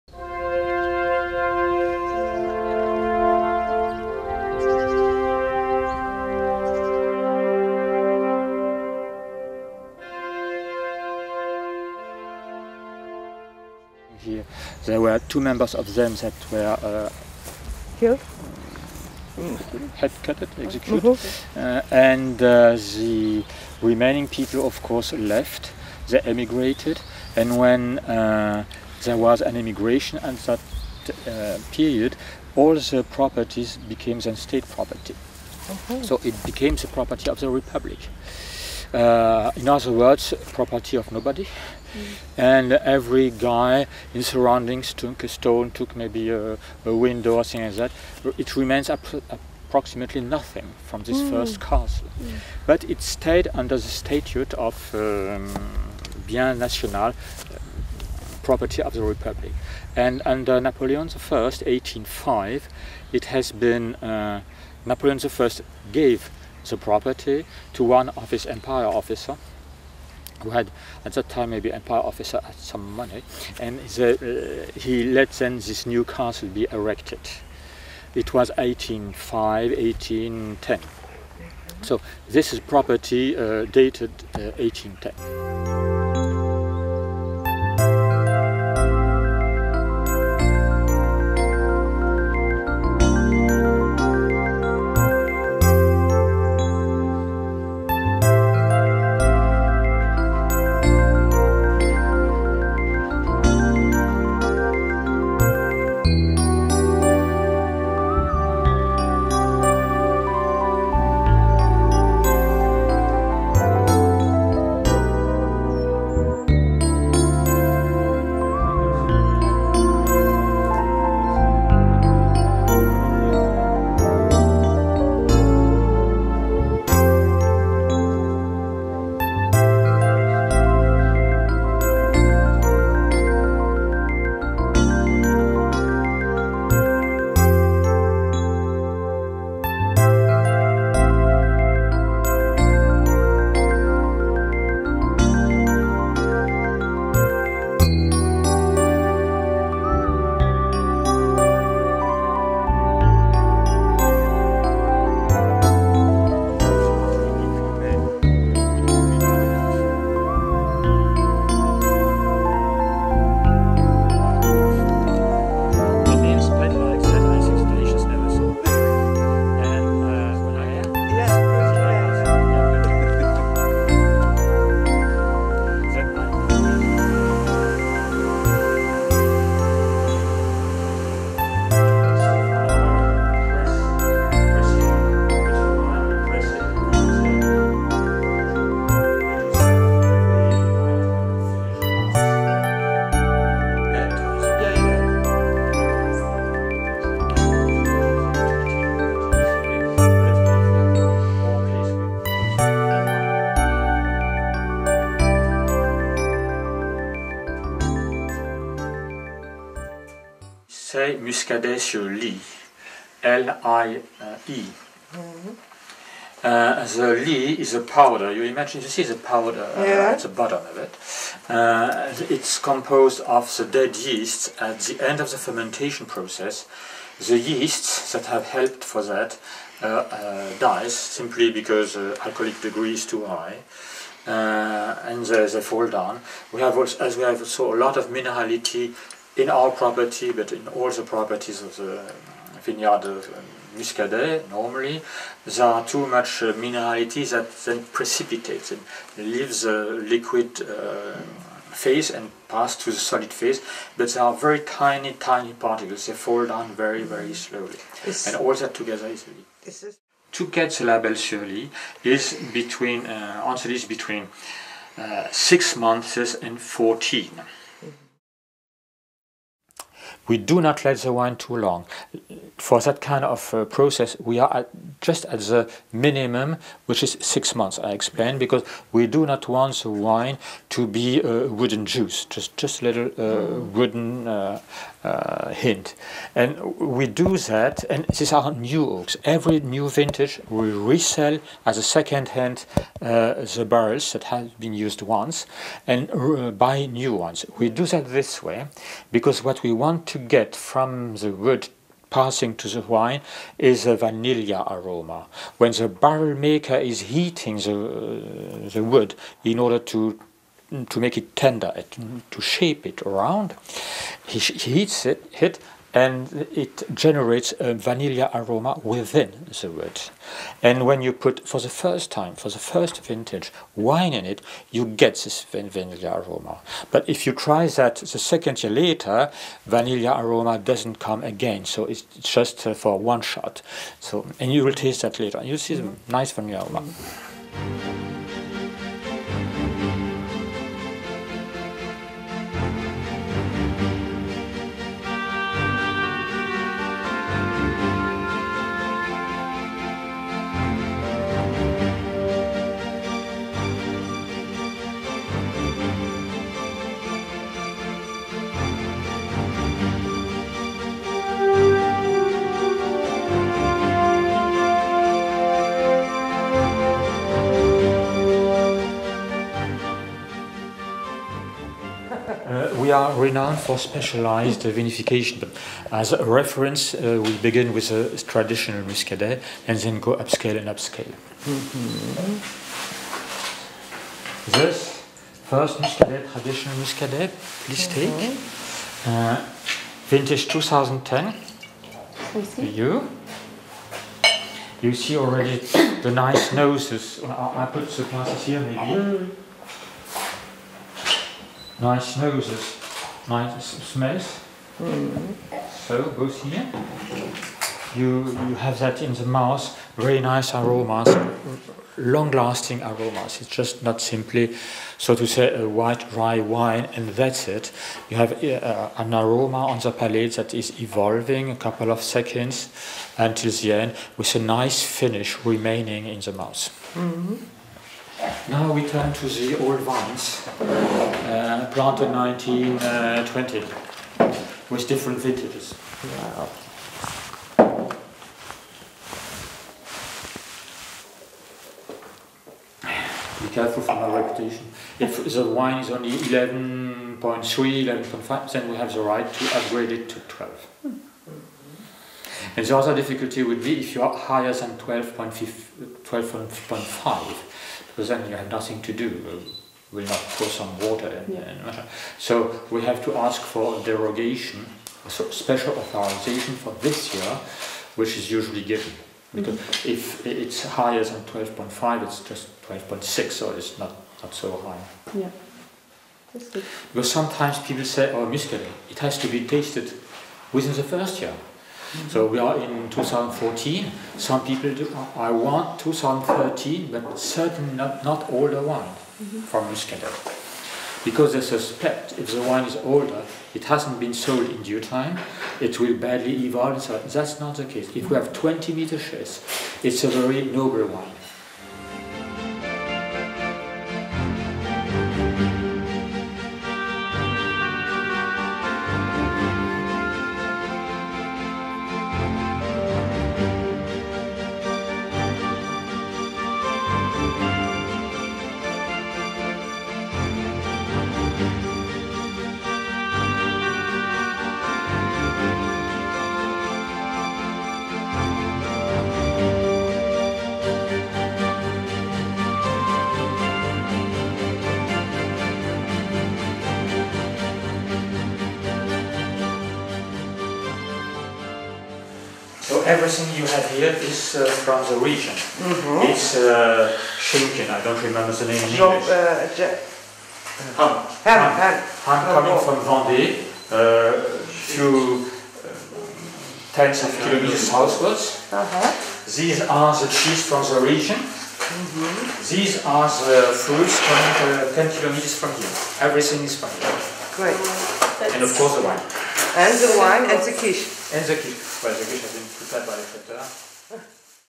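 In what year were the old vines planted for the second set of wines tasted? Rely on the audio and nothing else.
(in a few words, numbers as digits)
1920.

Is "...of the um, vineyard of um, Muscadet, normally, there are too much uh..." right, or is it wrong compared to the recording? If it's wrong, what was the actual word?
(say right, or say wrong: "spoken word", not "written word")
right.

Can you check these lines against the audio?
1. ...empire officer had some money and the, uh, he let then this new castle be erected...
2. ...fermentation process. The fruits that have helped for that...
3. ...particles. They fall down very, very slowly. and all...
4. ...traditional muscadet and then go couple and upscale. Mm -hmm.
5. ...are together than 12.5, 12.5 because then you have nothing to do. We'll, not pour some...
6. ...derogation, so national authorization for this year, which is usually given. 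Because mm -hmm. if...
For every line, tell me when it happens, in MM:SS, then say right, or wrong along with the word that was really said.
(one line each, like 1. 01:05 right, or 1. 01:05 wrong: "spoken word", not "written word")
1. 01:11 right
2. 03:45 wrong: "yeasts", not "fruits"
3. 04:15 right
4. 06:18 wrong: "upscale", not "couple"
5. 07:34 wrong: "higher", not "together"
6. 07:43 wrong: "special", not "national".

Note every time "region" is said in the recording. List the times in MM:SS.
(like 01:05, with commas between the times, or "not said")
09:05, 09:20.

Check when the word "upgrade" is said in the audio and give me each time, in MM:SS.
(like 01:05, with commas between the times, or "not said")
07:29.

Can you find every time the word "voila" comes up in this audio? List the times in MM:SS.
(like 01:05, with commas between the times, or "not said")
not said.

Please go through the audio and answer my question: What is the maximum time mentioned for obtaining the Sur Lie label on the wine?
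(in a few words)
14 months.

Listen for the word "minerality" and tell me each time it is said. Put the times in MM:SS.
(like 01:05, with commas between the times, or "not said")
03:58, 04:06.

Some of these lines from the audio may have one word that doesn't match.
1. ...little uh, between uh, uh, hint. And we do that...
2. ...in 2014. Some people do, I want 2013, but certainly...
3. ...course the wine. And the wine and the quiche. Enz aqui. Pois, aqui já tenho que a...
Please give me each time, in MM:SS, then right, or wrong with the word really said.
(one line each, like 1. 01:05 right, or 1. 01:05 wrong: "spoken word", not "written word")
1. 04:42 wrong: "wooden", not "between"
2. 08:02 right
3. 09:28 right.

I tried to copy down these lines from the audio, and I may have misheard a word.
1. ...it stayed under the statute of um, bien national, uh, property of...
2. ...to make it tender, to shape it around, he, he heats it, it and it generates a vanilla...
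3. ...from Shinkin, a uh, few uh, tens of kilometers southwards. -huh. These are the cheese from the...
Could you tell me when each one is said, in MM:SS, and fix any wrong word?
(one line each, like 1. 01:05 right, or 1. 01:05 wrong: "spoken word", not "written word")
1. 00:52 right
2. 05:10 right
3. 09:12 wrong: "Vendée", not "Shinkin".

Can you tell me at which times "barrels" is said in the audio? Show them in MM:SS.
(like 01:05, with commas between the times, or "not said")
04:53, 05:05.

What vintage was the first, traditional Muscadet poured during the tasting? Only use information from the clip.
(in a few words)
2010.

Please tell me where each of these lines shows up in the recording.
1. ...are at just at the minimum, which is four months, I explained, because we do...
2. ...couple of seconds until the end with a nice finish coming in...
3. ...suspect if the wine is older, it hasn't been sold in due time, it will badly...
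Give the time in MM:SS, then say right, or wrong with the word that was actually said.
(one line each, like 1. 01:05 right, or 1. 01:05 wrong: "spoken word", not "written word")
1. 04:34 wrong: "six", not "four"
2. 07:01 wrong: "remaining", not "coming"
3. 08:11 right.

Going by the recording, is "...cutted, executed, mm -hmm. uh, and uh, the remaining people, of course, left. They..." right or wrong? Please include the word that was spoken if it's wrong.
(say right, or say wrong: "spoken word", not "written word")
right.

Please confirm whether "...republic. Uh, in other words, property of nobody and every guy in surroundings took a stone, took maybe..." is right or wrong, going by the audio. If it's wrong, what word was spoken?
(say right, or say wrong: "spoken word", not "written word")
right.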